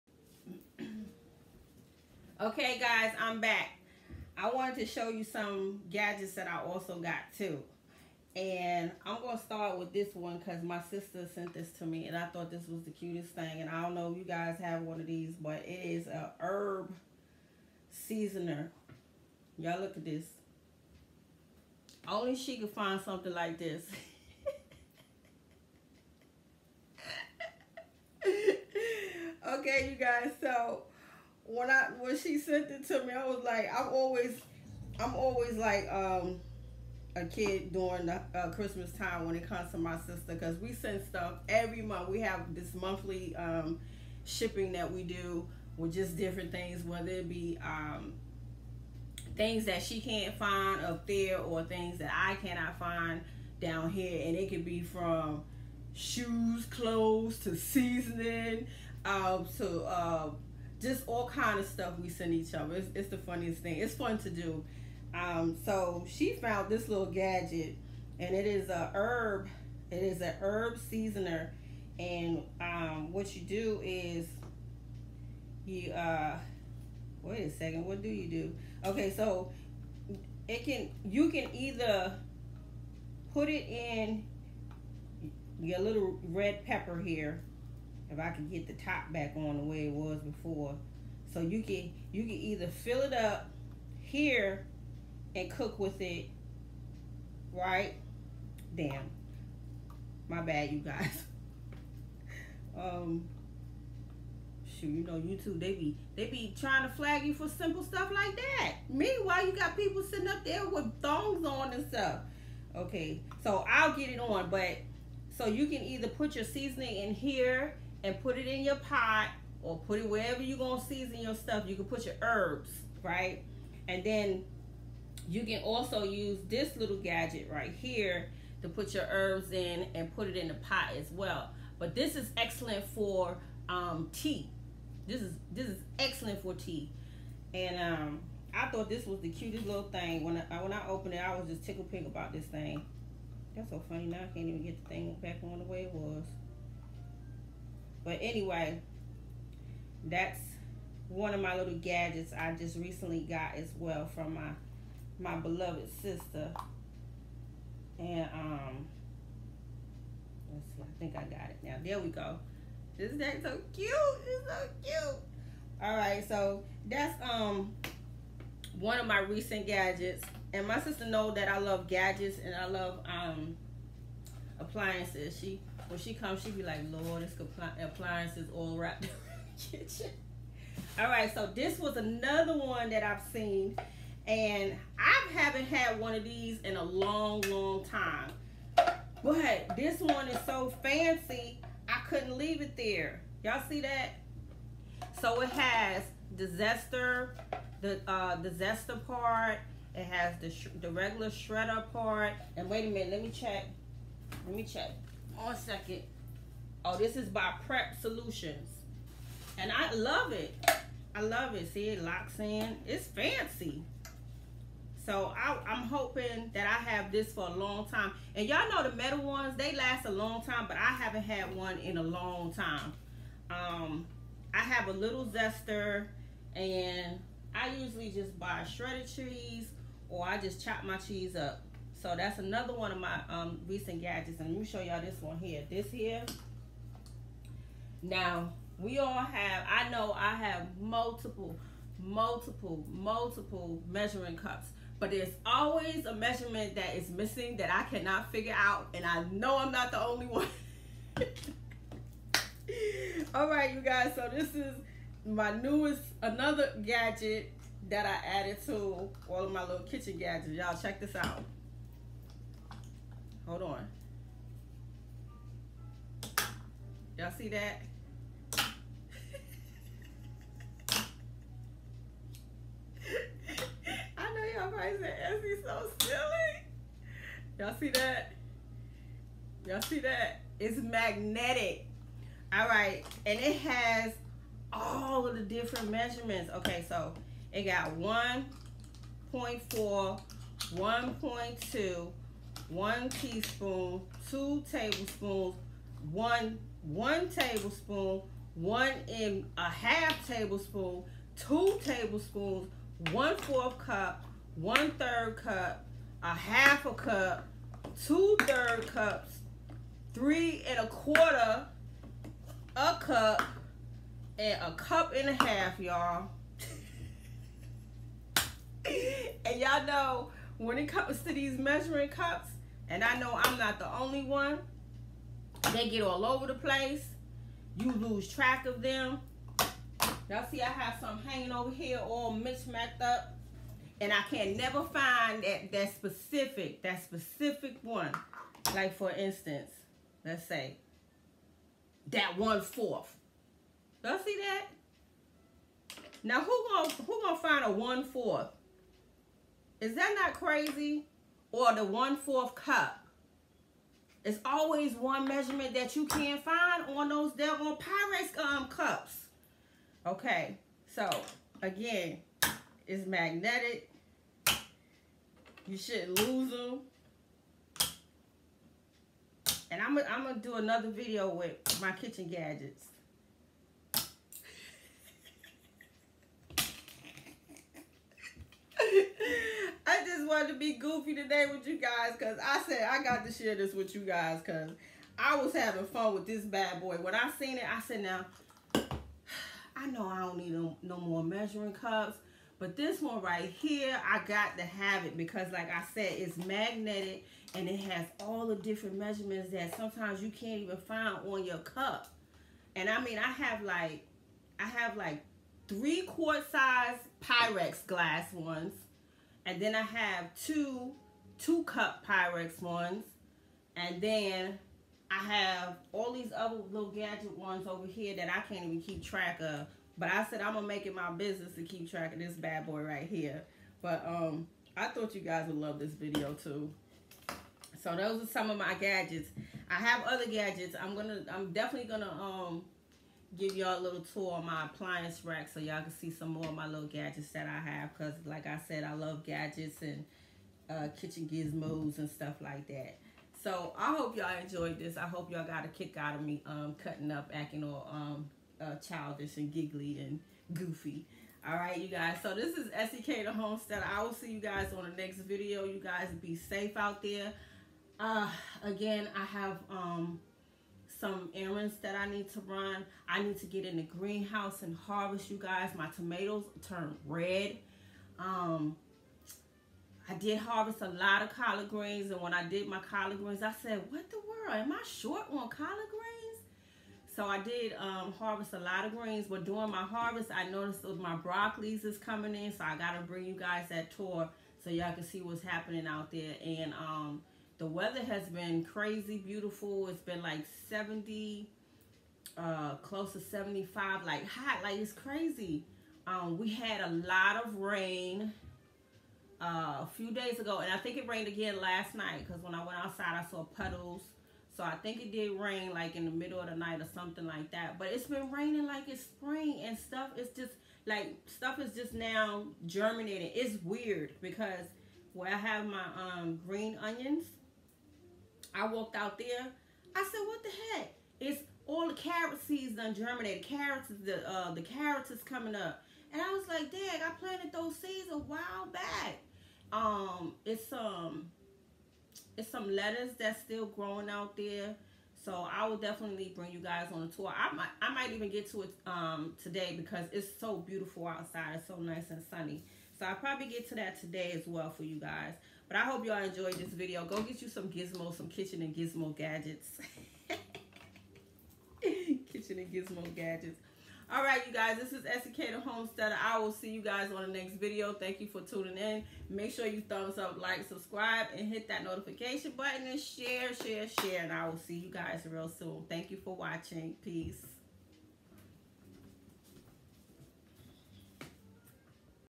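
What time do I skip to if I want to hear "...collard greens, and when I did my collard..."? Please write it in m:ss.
7:51.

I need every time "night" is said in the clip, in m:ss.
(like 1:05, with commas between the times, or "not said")
8:21, 8:26.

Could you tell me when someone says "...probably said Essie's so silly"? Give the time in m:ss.
4:34.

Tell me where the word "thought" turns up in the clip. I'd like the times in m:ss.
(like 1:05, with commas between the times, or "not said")
0:12, 2:18, 7:04.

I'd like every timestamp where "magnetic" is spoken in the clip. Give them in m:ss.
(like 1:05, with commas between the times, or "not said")
4:40, 6:03, 6:36.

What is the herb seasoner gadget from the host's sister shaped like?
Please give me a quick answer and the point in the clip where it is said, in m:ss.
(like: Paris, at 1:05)
red pepper, at 1:26.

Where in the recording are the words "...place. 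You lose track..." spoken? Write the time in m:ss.
5:26.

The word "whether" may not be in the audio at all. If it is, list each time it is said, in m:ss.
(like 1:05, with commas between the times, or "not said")
0:46.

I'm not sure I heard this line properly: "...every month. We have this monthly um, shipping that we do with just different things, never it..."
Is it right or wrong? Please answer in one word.
wrong.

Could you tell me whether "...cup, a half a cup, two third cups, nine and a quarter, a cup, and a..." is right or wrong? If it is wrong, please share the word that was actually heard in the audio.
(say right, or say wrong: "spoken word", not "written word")
wrong: "three", not "nine".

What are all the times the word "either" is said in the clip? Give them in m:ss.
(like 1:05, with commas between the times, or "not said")
1:21, 1:32, 1:55.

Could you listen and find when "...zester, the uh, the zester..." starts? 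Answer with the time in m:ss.
3:16.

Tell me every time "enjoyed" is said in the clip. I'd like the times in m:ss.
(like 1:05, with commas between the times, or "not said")
7:24, 9:06.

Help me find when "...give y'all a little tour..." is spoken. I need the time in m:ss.
7:13.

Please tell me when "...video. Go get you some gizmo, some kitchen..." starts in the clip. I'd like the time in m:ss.
9:06.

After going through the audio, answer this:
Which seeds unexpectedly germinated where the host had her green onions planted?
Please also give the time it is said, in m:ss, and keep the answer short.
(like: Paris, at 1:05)
carrot seeds, at 8:41.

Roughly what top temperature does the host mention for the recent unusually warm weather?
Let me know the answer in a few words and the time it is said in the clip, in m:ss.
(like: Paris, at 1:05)
75, at 8:13.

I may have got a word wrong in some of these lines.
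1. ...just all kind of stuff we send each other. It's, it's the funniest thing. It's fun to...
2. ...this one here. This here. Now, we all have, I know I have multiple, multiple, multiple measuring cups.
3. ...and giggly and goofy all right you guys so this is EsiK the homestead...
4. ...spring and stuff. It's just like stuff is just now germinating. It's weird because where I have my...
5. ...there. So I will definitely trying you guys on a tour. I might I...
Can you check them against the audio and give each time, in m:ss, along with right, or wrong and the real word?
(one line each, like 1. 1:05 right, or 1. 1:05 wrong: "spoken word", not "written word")
1. 1:00 right
2. 3:55 right
3. 7:29 right
4. 8:29 right
5. 8:54 wrong: "bring", not "trying".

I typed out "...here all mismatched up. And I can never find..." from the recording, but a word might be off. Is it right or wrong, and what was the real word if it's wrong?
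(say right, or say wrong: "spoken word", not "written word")
right.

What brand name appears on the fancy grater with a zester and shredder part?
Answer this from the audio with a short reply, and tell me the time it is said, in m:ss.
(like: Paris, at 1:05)
Prep Solutions, at 3:27.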